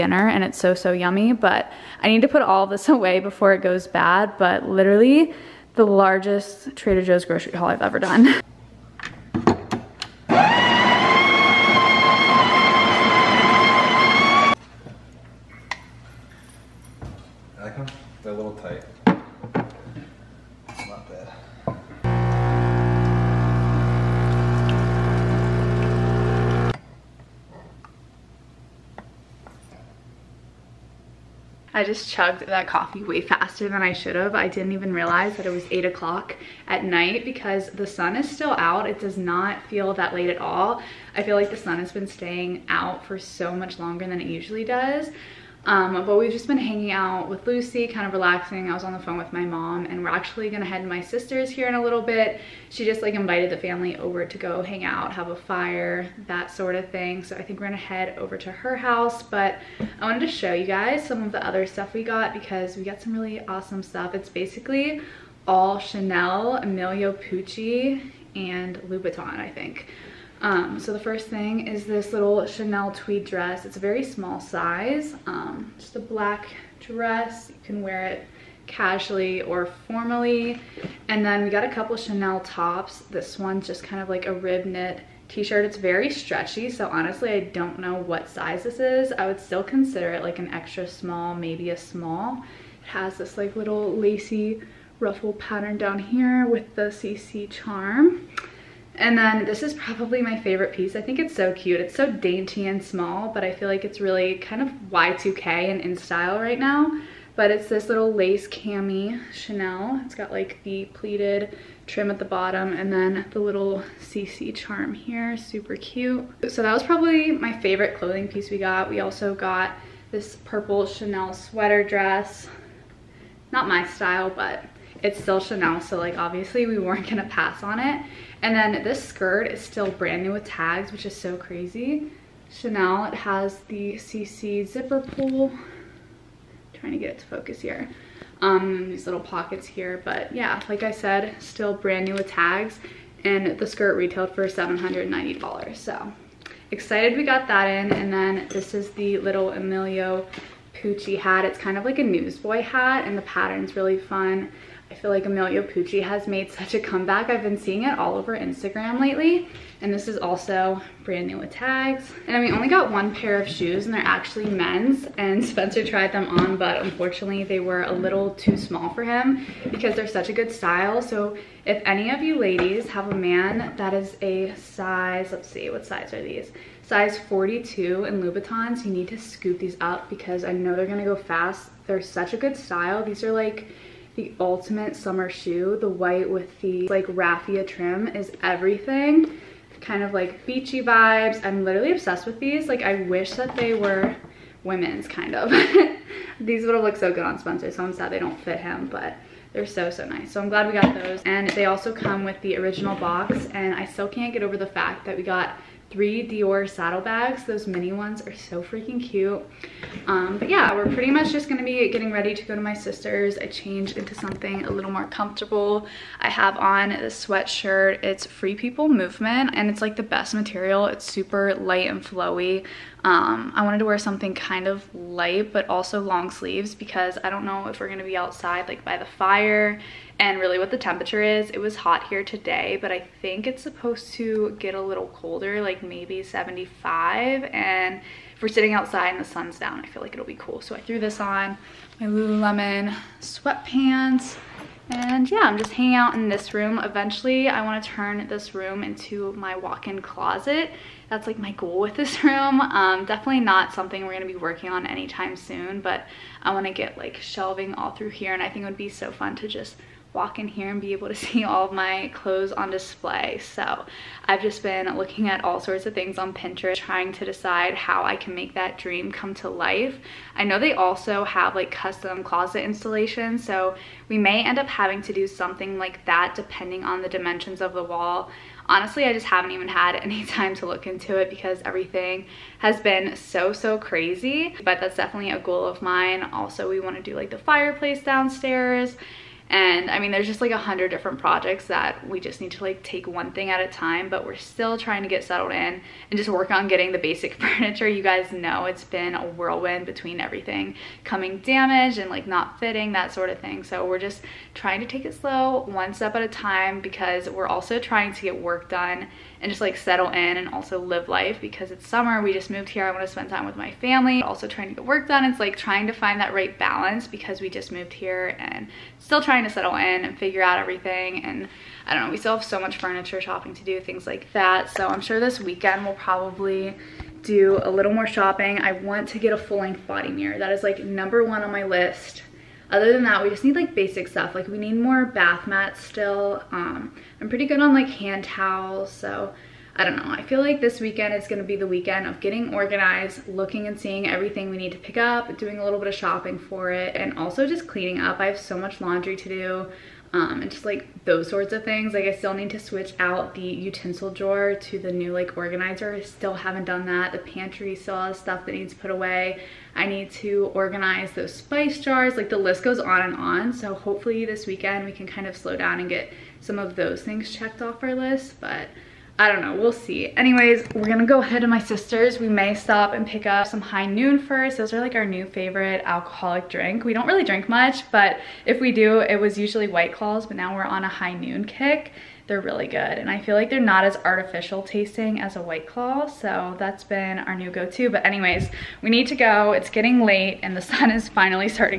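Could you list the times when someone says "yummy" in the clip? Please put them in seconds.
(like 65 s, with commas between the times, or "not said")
0 s.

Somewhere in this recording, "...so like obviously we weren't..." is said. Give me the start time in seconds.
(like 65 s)
125 s.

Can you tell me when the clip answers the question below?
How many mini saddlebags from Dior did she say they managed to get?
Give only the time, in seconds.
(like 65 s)
205 s.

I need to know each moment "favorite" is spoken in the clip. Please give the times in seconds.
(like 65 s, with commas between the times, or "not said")
100 s, 117 s, 375 s.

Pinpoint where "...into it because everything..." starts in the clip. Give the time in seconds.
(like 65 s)
280 s.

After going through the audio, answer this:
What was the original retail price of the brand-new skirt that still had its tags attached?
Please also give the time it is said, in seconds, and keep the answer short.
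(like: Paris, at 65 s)
$790, at 144 s.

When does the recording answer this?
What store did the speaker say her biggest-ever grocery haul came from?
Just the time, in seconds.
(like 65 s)
6 s.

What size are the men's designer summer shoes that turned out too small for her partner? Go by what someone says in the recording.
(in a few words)
42.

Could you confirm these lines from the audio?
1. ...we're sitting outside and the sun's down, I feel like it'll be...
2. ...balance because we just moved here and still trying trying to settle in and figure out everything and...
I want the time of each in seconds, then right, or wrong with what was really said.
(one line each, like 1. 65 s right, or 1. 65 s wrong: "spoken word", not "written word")
1. 238 s right
2. 316 s right.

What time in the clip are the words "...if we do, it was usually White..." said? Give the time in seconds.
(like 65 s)
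378 s.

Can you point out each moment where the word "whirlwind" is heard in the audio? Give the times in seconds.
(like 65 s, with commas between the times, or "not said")
299 s.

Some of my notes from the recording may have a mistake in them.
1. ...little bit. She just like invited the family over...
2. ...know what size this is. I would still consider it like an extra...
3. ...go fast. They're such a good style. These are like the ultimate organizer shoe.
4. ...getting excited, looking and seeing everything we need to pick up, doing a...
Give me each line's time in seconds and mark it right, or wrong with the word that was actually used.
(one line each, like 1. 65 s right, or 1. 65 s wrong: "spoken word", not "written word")
1. 51 s right
2. 87 s right
3. 181 s wrong: "summer", not "organizer"
4. 342 s wrong: "organized", not "excited".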